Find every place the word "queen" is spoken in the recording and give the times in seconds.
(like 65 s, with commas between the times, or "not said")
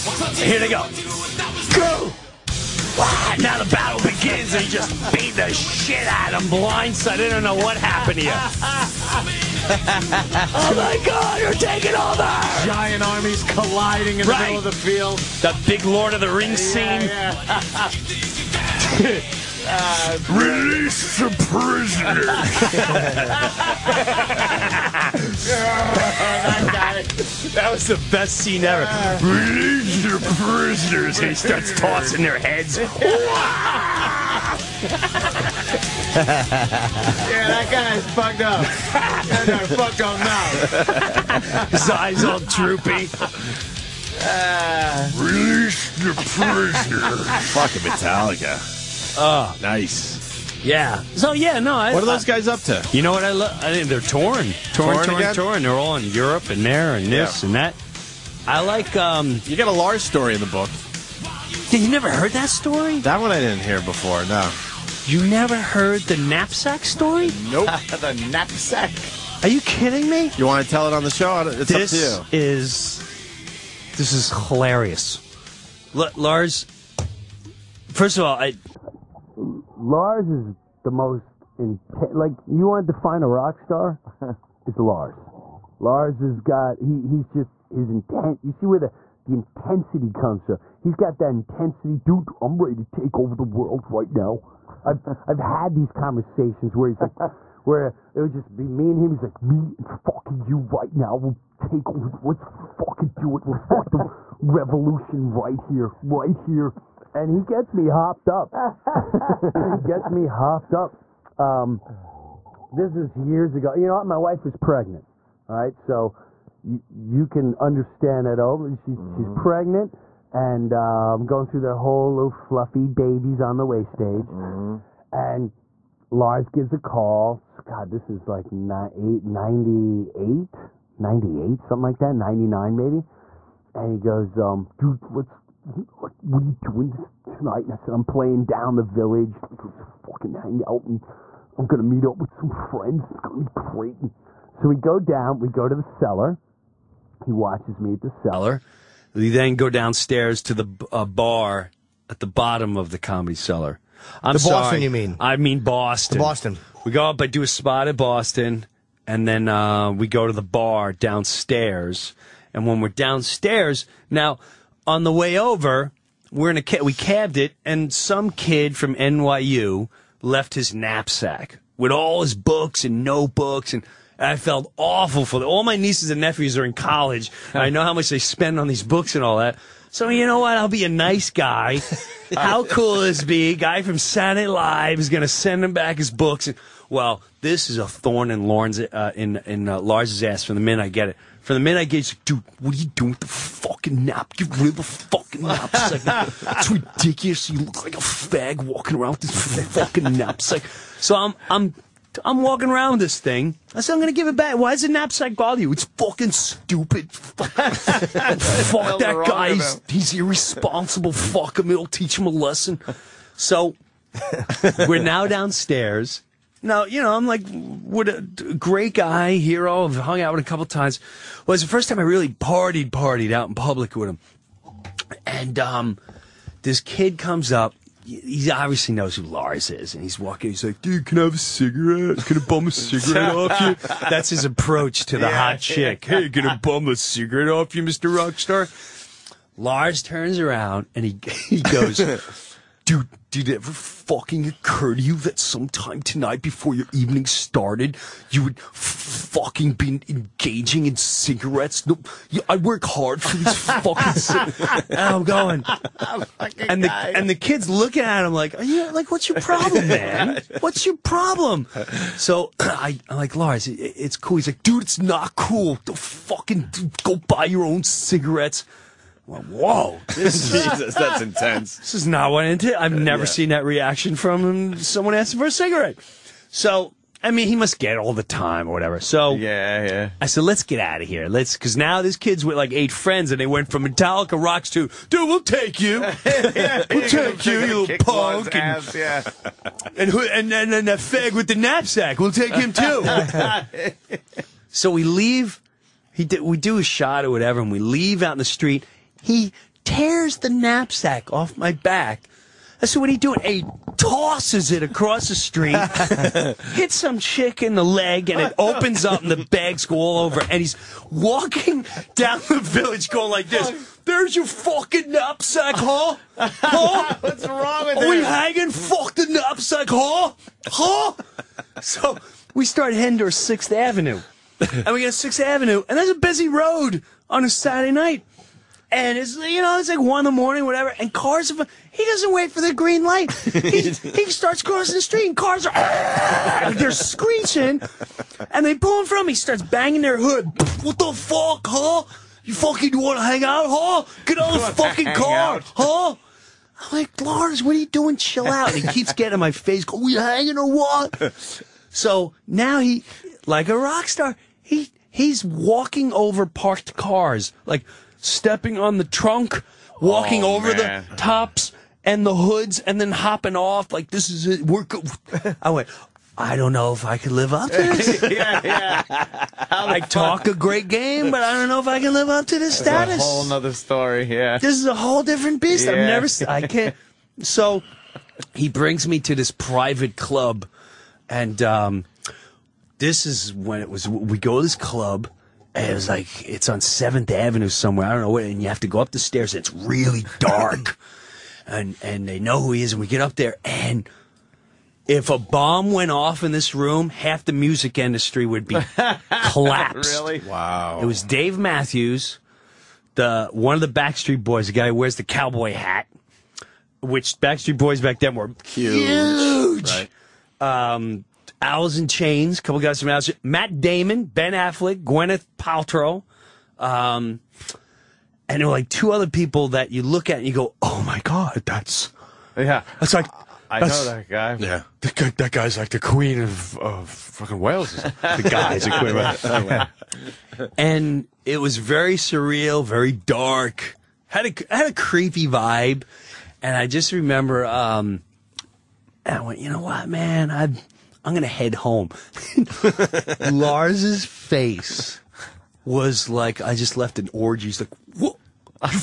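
426 s, 430 s.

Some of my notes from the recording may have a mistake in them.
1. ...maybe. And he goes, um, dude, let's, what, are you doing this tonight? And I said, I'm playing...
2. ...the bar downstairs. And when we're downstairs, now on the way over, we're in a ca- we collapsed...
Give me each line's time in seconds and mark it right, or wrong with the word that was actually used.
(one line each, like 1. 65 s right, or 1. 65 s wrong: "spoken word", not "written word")
1. 132 s right
2. 160 s wrong: "cabbed", not "collapsed".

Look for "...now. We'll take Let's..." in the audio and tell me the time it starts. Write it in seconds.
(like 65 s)
100 s.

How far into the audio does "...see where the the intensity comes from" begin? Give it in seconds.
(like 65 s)
88 s.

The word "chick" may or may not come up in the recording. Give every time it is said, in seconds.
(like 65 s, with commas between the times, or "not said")
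235 s, 307 s.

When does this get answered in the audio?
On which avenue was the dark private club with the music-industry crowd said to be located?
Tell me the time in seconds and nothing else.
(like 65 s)
386 s.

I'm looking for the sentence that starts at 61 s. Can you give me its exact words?
Did you never heard that story?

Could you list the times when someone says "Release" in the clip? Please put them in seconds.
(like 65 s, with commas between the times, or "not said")
20 s, 29 s, 45 s.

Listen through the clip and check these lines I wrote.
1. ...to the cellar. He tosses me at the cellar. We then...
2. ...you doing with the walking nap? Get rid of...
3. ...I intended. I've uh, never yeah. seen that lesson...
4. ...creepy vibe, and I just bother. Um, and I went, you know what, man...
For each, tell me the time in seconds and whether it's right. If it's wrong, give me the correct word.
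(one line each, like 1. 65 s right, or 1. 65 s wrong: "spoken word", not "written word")
1. 145 s wrong: "watches", not "tosses"
2. 192 s wrong: "fucking", not "walking"
3. 272 s wrong: "reaction", not "lesson"
4. 434 s wrong: "remember", not "bother".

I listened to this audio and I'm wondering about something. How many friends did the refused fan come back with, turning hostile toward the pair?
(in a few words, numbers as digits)
8.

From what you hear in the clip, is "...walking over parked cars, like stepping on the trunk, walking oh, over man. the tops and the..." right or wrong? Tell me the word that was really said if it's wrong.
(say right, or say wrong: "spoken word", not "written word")
right.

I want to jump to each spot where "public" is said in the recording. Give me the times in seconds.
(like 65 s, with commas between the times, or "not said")
223 s.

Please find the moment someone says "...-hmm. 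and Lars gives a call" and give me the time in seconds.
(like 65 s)
124 s.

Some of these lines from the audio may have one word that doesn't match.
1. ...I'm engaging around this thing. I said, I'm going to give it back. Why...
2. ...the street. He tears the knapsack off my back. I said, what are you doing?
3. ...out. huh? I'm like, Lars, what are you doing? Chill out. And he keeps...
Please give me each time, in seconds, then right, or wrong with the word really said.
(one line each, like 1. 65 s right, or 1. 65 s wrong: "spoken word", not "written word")
1. 202 s wrong: "walking", not "engaging"
2. 298 s right
3. 345 s right.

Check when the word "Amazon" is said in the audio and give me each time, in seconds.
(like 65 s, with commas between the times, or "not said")
not said.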